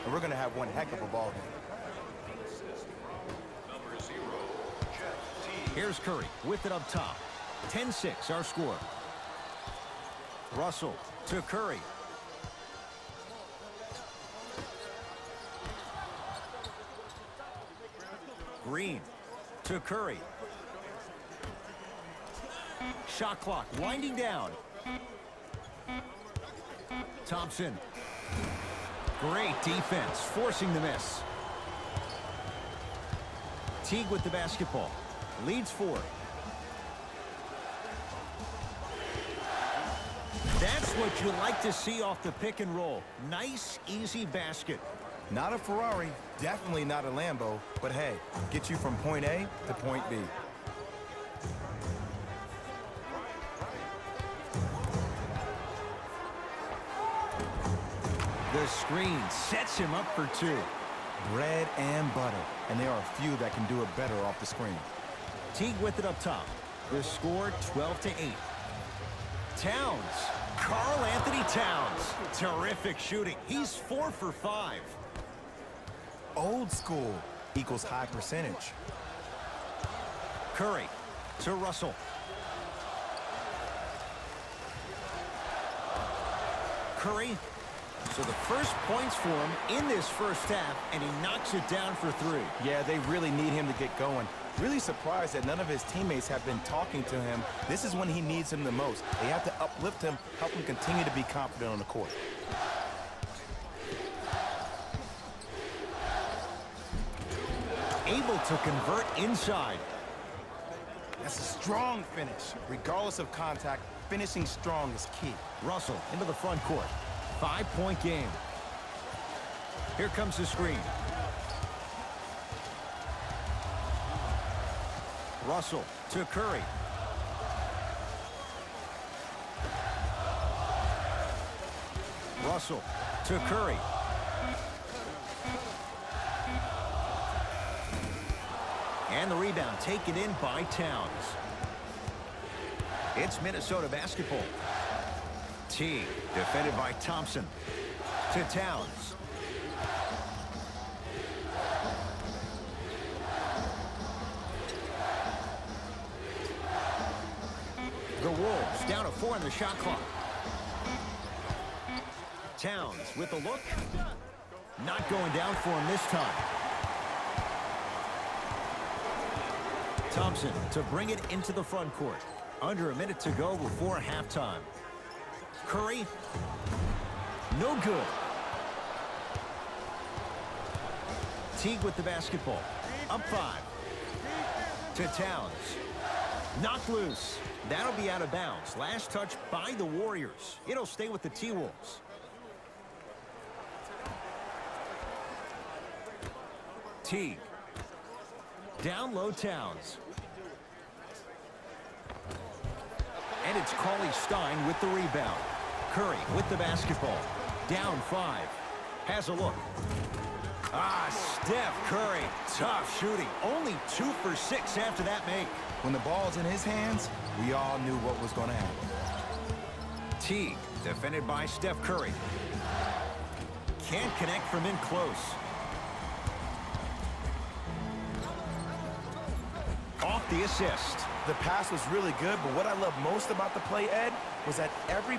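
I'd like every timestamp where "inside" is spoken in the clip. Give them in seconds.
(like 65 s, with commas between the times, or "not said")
109 s.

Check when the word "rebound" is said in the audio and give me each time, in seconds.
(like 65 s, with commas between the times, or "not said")
139 s, 204 s.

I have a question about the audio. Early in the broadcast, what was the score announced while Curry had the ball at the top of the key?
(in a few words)
10-6.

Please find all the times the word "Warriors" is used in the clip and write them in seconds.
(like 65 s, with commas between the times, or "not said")
189 s.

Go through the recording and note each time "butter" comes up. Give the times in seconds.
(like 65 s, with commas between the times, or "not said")
62 s.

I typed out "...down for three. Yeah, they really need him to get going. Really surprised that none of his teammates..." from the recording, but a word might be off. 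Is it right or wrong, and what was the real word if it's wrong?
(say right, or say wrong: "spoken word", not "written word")
right.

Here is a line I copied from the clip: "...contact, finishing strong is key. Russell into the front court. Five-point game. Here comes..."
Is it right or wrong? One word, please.
right.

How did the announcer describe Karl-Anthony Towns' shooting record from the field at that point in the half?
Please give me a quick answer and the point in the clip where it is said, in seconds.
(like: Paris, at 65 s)
four for five, at 73 s.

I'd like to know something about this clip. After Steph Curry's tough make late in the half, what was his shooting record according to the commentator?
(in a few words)
two for six.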